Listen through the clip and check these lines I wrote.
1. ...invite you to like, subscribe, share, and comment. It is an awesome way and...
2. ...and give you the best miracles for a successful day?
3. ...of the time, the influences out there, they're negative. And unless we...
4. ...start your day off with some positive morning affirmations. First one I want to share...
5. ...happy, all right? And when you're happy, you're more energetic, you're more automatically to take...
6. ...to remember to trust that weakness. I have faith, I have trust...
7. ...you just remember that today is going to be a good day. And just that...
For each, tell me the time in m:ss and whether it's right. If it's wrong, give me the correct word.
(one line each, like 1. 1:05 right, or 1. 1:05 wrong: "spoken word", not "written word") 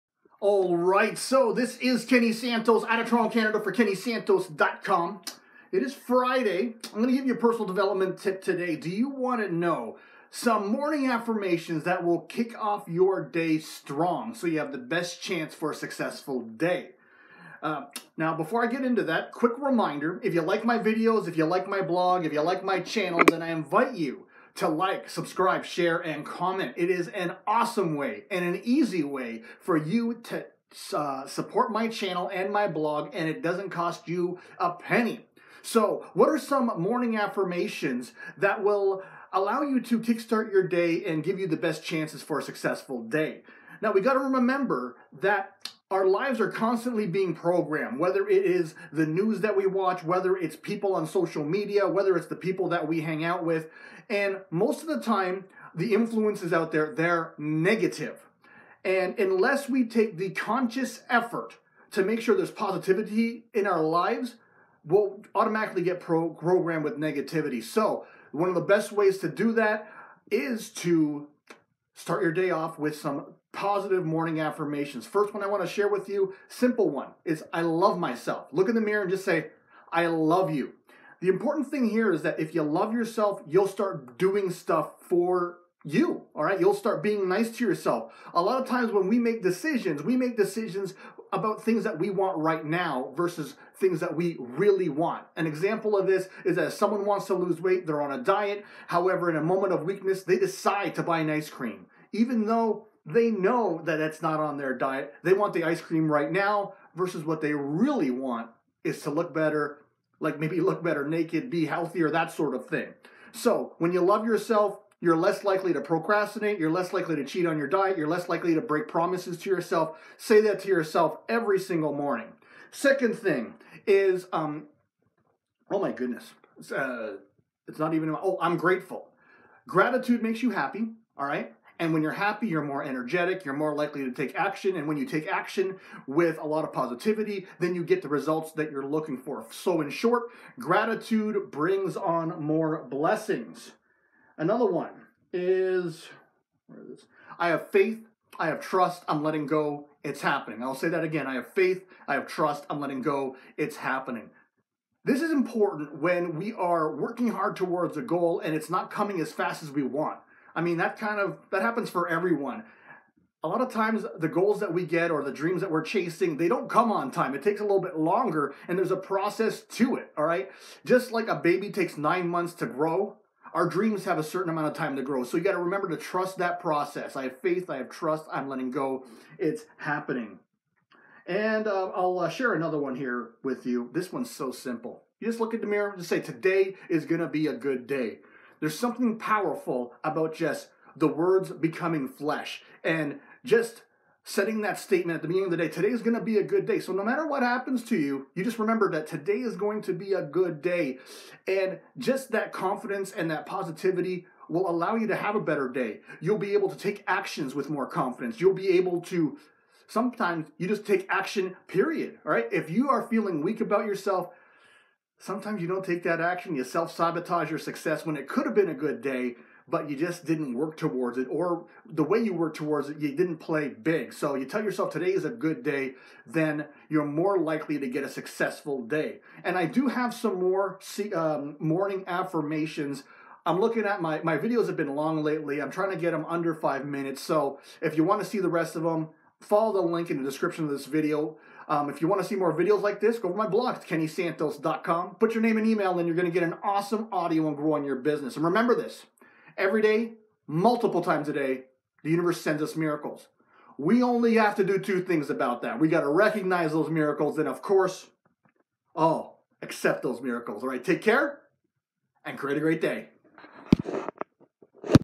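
1. 0:23 right
2. 0:41 wrong: "chances", not "miracles"
3. 0:54 right
4. 1:11 right
5. 2:10 wrong: "likely", not "automatically"
6. 2:55 wrong: "process", not "weakness"
7. 3:18 right.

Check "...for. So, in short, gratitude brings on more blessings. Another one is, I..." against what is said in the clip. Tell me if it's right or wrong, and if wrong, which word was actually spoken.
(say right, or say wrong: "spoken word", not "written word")
right.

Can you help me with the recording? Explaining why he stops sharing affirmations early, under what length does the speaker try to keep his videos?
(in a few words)
5 minutes.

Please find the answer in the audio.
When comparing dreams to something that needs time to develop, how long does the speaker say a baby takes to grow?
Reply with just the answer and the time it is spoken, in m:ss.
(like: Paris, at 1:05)
9 months, at 2:51.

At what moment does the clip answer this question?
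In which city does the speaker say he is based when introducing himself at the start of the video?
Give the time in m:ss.
0:03.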